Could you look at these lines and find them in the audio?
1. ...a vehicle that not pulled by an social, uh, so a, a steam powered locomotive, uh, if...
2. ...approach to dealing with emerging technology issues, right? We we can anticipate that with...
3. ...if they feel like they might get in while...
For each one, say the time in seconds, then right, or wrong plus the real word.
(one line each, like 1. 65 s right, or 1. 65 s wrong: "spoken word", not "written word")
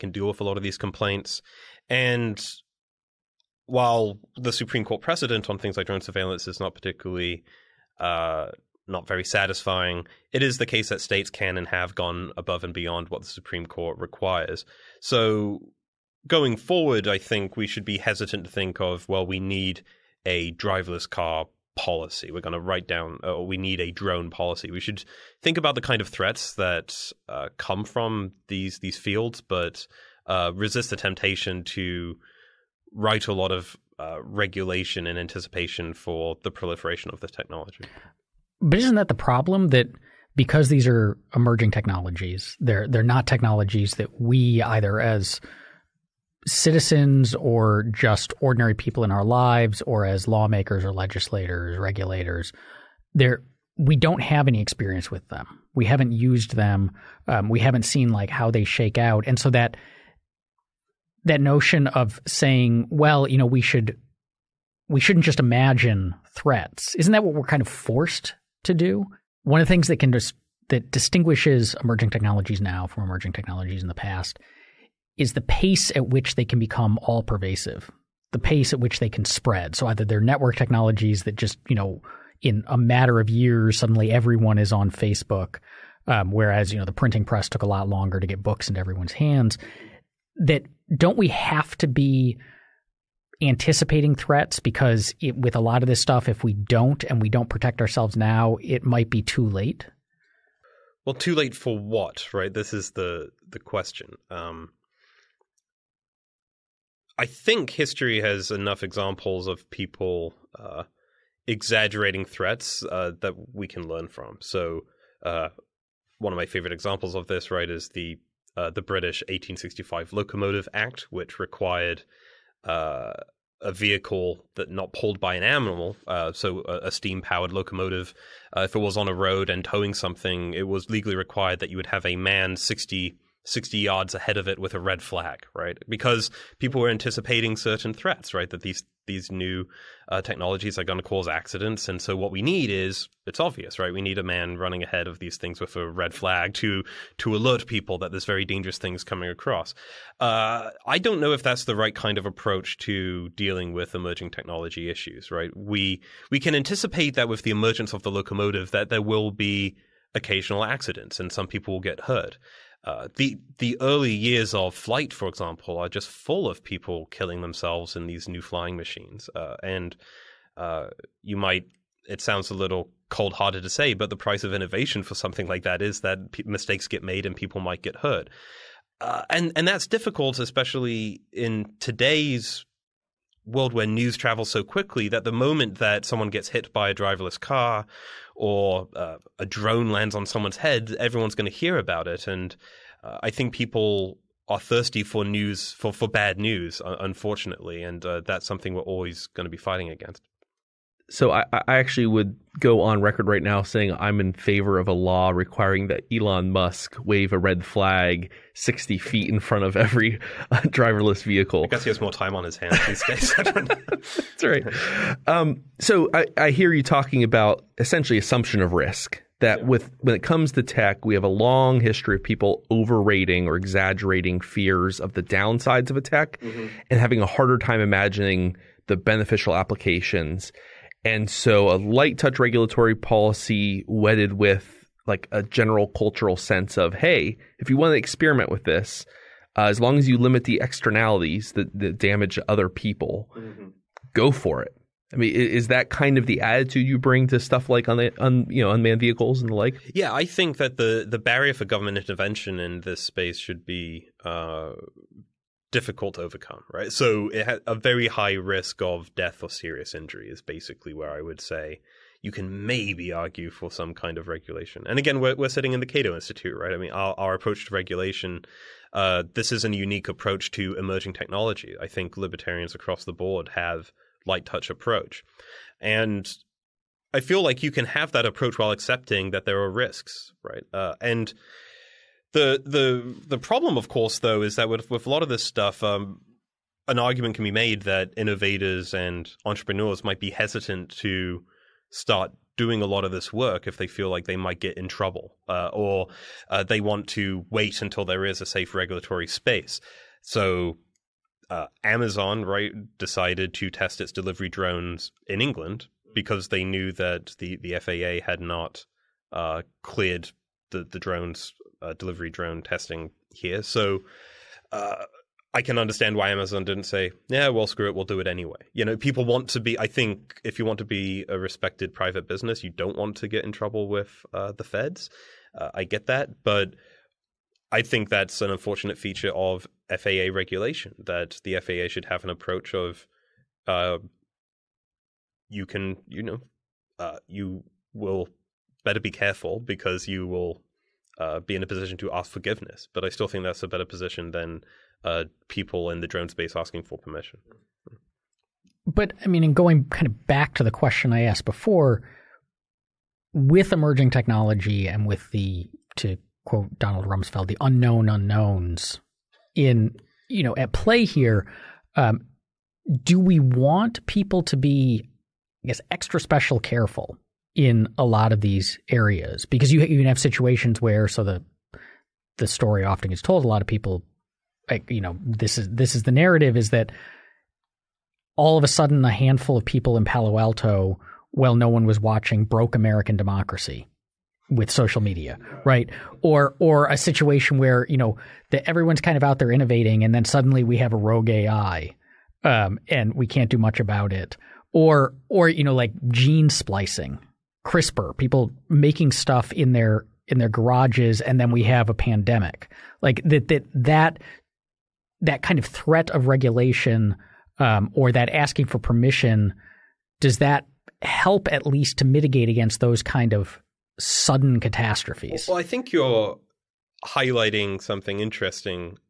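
1. 123 s wrong: "animal", not "social"
2. 152 s right
3. 293 s wrong: "trouble", not "while".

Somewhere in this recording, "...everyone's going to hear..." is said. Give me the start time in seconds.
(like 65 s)
190 s.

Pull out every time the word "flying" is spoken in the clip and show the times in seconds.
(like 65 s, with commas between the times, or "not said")
168 s.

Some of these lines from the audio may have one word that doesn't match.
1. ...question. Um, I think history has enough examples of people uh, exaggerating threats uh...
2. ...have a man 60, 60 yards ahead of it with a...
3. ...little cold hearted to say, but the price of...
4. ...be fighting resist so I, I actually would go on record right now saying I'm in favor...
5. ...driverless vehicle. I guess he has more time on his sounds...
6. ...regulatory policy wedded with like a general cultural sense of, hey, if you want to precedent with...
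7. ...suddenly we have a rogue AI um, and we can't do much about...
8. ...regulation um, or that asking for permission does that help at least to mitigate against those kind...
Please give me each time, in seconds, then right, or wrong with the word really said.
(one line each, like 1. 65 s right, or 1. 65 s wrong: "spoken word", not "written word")
1. 103 s right
2. 131 s right
3. 172 s right
4. 199 s wrong: "against", not "resist"
5. 210 s wrong: "hands", not "sounds"
6. 232 s wrong: "experiment", not "precedent"
7. 390 s right
8. 406 s right.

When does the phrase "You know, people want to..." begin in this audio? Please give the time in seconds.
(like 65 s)
318 s.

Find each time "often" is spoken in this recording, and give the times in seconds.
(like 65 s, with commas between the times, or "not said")
372 s.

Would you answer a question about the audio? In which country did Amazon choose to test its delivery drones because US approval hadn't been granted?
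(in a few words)
England.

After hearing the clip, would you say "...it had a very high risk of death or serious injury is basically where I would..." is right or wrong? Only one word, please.
right.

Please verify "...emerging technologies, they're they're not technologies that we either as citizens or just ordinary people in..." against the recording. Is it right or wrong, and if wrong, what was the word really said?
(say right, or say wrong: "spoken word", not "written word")
right.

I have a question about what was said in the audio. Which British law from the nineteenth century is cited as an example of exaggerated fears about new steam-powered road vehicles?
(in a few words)
1865 Locomotive Act.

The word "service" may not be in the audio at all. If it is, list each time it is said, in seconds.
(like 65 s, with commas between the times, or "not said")
not said.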